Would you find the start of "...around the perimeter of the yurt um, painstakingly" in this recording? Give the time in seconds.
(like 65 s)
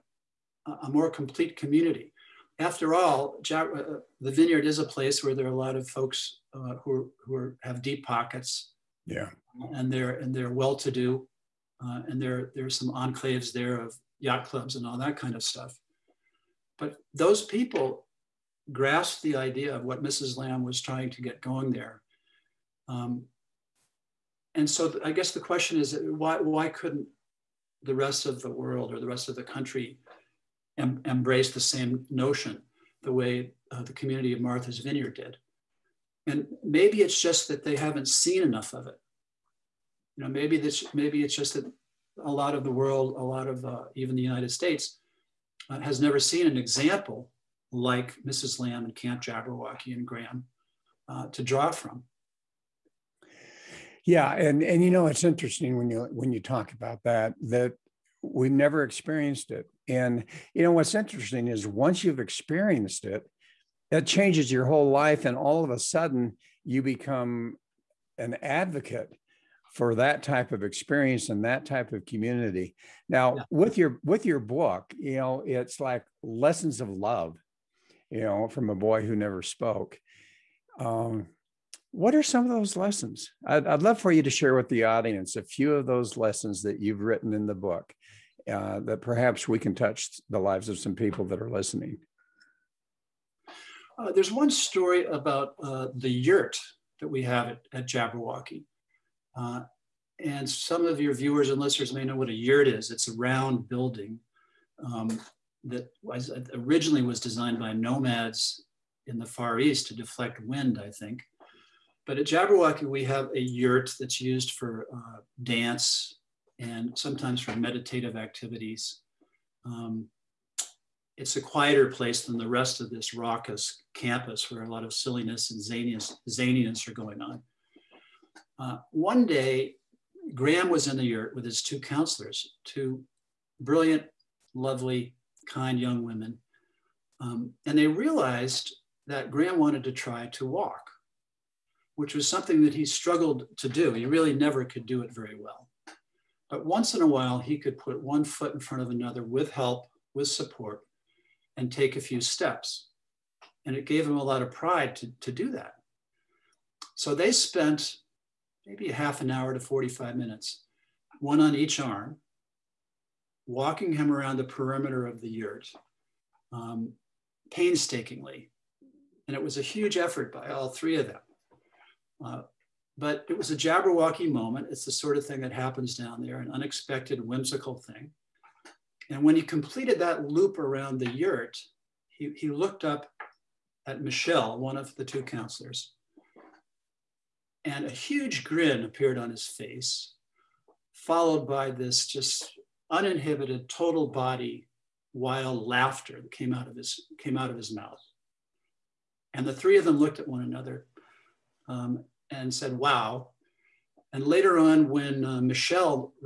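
164 s.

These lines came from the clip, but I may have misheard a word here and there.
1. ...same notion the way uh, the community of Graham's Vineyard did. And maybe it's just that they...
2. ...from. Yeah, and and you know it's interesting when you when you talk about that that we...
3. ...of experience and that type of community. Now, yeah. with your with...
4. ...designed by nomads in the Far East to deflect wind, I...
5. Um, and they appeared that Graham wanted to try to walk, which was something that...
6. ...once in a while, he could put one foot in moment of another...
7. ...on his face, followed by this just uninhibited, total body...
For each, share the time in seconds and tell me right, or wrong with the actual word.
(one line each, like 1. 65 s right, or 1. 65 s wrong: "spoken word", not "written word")
1. 31 s wrong: "Martha", not "Graham"
2. 51 s right
3. 70 s right
4. 107 s right
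5. 137 s wrong: "realized", not "appeared"
6. 146 s wrong: "front", not "moment"
7. 189 s right.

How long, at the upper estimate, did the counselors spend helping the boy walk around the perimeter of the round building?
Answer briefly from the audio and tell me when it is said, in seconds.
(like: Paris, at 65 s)
45 minutes, at 159 s.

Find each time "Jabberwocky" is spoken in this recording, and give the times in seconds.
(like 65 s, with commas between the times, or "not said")
49 s, 97 s, 112 s, 173 s.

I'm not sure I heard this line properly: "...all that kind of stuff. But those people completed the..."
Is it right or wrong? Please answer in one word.
wrong.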